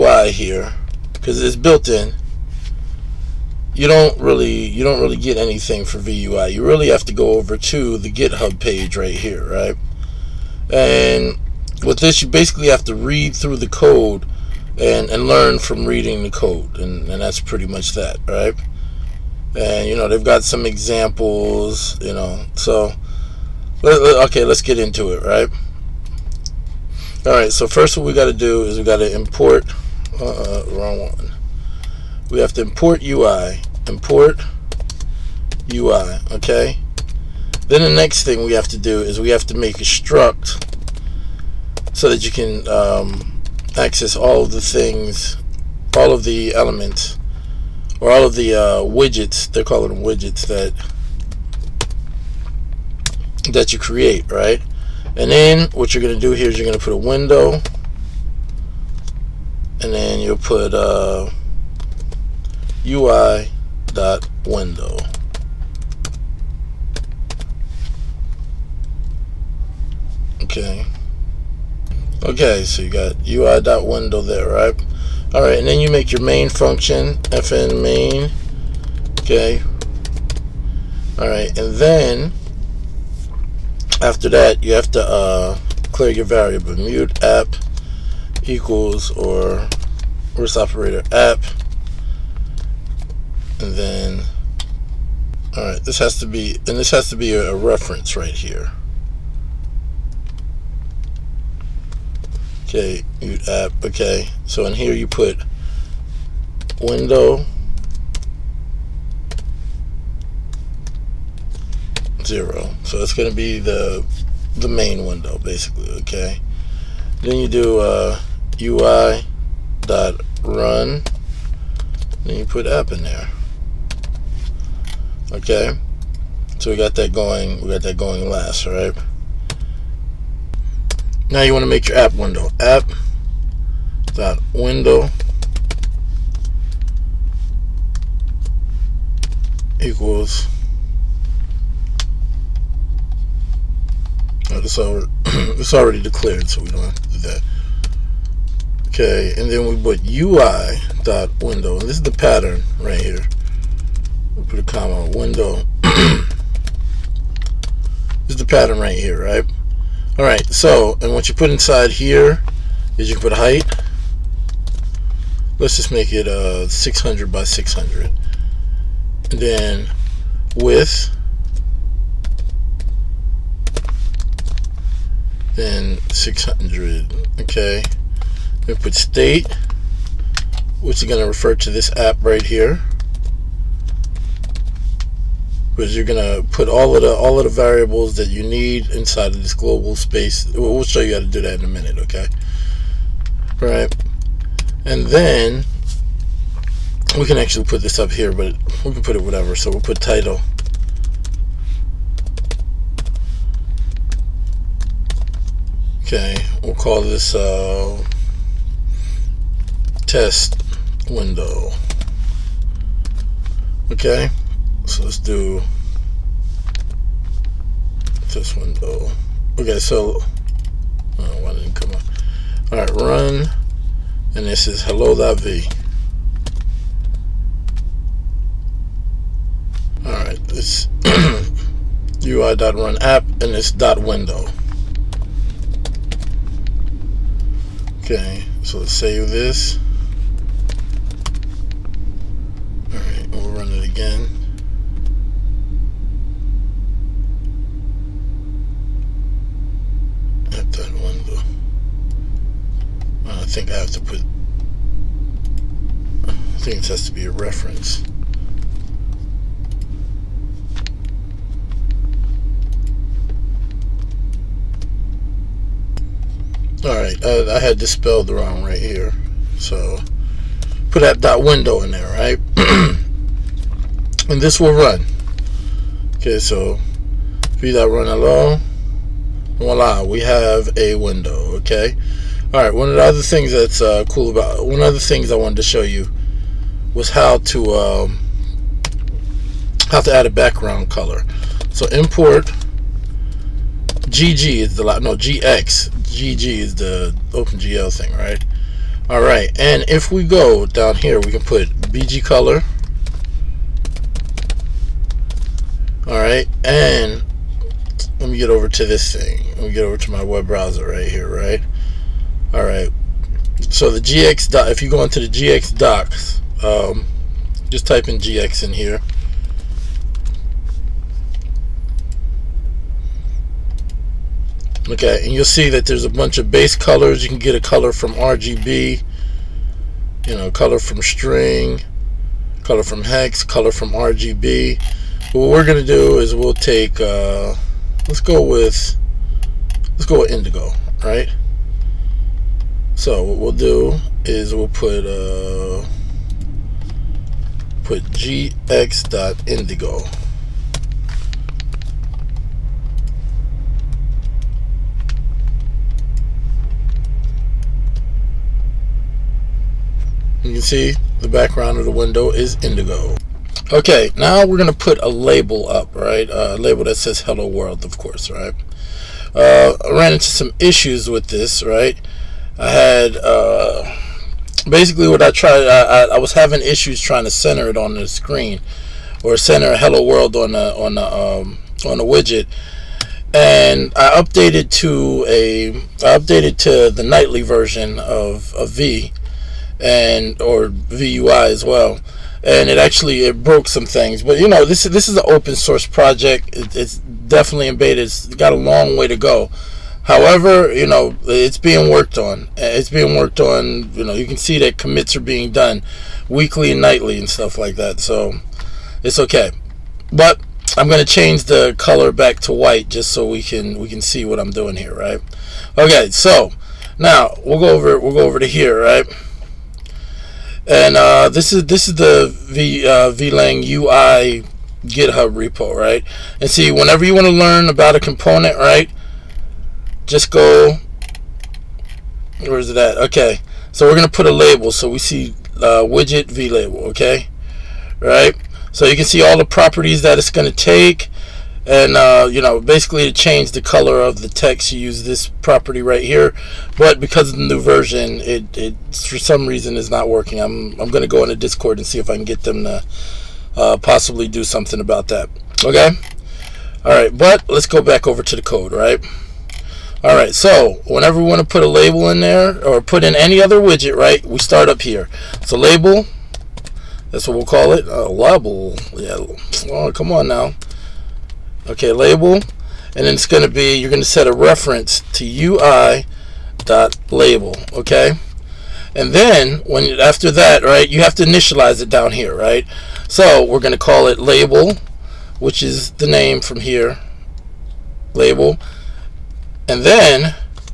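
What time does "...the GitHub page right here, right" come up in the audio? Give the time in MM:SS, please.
00:07.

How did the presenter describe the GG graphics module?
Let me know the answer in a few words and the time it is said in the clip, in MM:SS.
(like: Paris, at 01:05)
the OpenGL thing, at 04:57.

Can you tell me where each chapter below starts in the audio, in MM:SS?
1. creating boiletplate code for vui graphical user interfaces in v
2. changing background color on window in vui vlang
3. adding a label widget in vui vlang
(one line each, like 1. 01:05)
1. 00:29
2. 04:51
3. 07:36.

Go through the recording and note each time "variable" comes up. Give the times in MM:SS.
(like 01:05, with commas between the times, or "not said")
01:26, 03:07.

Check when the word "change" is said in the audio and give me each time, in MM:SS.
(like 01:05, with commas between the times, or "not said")
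06:51, 07:23.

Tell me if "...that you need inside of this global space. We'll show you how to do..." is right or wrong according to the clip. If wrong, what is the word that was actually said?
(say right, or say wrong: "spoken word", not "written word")
right.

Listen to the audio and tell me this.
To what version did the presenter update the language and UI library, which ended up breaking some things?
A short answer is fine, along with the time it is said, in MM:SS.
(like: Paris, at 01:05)
nightly version, at 06:27.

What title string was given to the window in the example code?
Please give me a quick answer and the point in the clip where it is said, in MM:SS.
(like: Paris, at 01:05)
test window, at 03:30.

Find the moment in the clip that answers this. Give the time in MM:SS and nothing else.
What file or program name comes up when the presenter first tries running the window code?
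03:44.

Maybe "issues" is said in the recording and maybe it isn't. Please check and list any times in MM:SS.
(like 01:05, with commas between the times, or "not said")
06:10, 06:16.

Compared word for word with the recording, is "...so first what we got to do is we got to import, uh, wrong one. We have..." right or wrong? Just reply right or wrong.
right.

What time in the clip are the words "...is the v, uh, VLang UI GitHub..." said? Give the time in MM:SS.
07:01.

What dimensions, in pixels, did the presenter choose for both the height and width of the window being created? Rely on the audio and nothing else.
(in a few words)
600.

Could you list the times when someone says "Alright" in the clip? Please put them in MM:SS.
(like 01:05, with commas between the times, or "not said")
04:26.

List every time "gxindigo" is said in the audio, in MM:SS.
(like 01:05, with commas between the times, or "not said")
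05:48.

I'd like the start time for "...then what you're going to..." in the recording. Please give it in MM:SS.
00:55.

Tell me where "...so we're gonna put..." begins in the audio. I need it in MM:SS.
07:13.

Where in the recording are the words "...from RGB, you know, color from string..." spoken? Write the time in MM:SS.
05:27.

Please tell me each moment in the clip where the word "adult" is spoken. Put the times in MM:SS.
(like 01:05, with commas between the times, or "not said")
not said.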